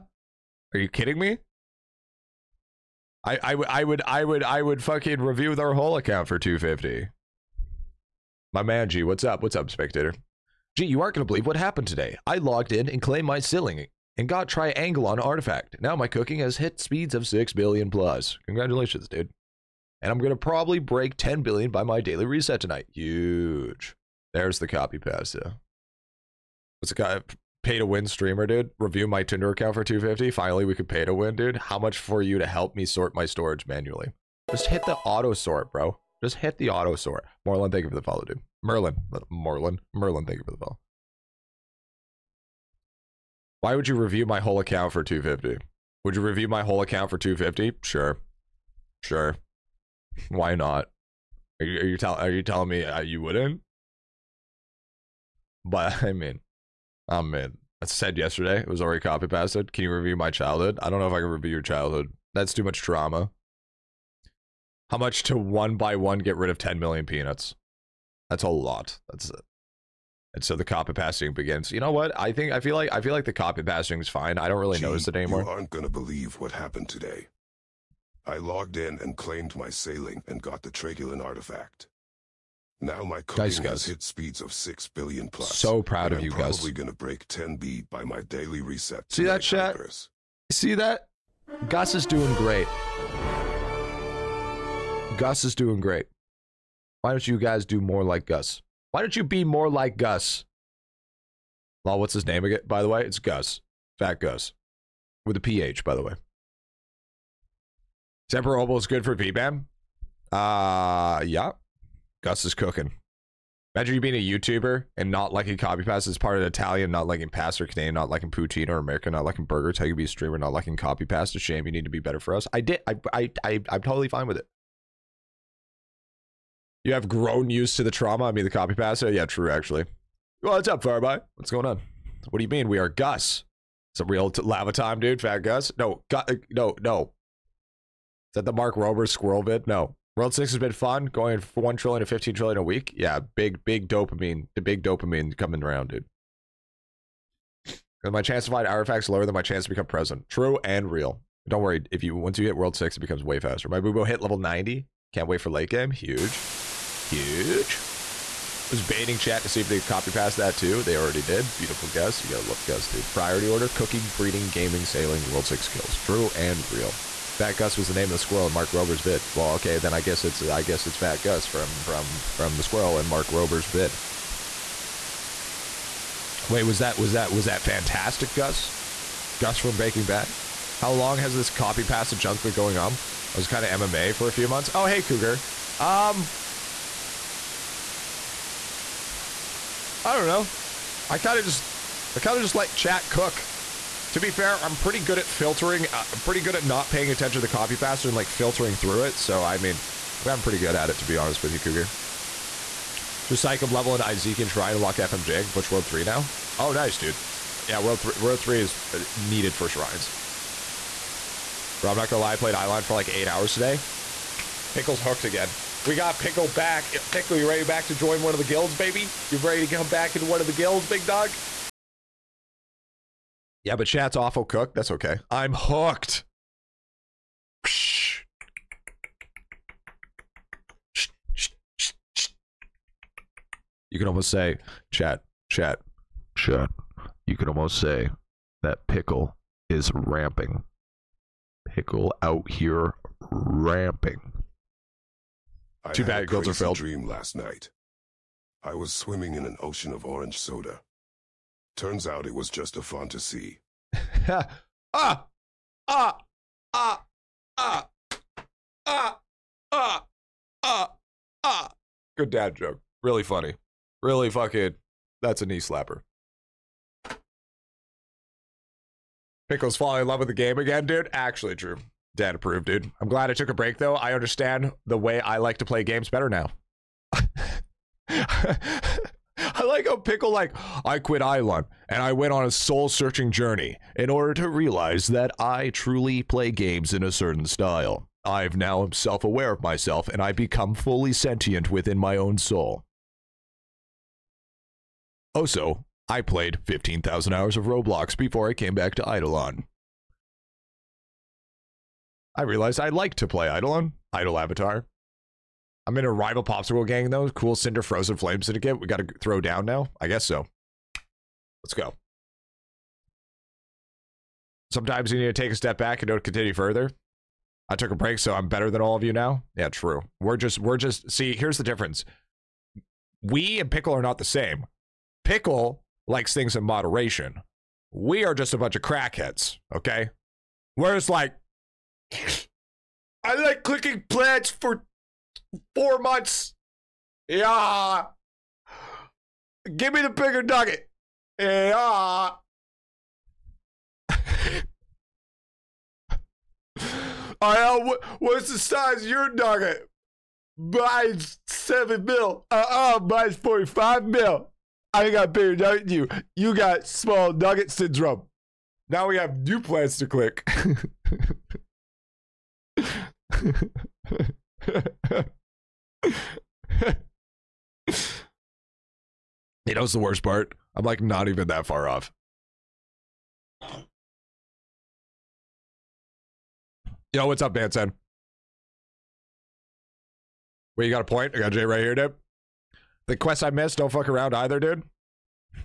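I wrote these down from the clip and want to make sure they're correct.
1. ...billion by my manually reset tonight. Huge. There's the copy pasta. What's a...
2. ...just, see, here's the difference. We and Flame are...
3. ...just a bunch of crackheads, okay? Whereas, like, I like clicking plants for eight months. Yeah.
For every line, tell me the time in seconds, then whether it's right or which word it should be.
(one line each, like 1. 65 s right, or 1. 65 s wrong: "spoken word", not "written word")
1. 21 s wrong: "daily", not "manually"
2. 320 s wrong: "Pickle", not "Flame"
3. 328 s wrong: "four", not "eight".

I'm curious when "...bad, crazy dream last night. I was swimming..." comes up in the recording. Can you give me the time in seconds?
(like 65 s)
246 s.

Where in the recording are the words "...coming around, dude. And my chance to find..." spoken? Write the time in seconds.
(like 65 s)
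145 s.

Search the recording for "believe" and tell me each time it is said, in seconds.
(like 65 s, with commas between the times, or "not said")
11 s, 75 s.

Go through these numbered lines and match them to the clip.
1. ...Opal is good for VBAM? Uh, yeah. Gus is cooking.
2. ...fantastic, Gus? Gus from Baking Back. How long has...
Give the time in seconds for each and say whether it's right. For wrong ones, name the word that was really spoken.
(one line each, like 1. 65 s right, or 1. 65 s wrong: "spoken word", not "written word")
1. 108 s right
2. 177 s right.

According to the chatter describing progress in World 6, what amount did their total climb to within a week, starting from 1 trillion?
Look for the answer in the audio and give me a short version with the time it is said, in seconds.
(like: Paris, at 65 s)
15 trillion, at 142 s.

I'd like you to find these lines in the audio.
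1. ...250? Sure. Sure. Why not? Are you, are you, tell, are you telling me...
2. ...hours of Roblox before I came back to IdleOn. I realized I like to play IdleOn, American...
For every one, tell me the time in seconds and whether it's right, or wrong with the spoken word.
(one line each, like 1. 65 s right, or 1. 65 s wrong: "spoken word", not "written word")
1. 47 s right
2. 297 s wrong: "Idol", not "American".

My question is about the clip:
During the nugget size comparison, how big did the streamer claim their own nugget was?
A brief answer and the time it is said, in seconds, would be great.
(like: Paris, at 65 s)
45 mil, at 353 s.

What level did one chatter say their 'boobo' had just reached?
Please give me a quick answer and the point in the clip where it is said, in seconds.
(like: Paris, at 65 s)
90, at 154 s.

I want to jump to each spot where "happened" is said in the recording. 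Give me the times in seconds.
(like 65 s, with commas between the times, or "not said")
11 s, 76 s.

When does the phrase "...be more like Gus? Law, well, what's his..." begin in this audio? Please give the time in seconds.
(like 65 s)
99 s.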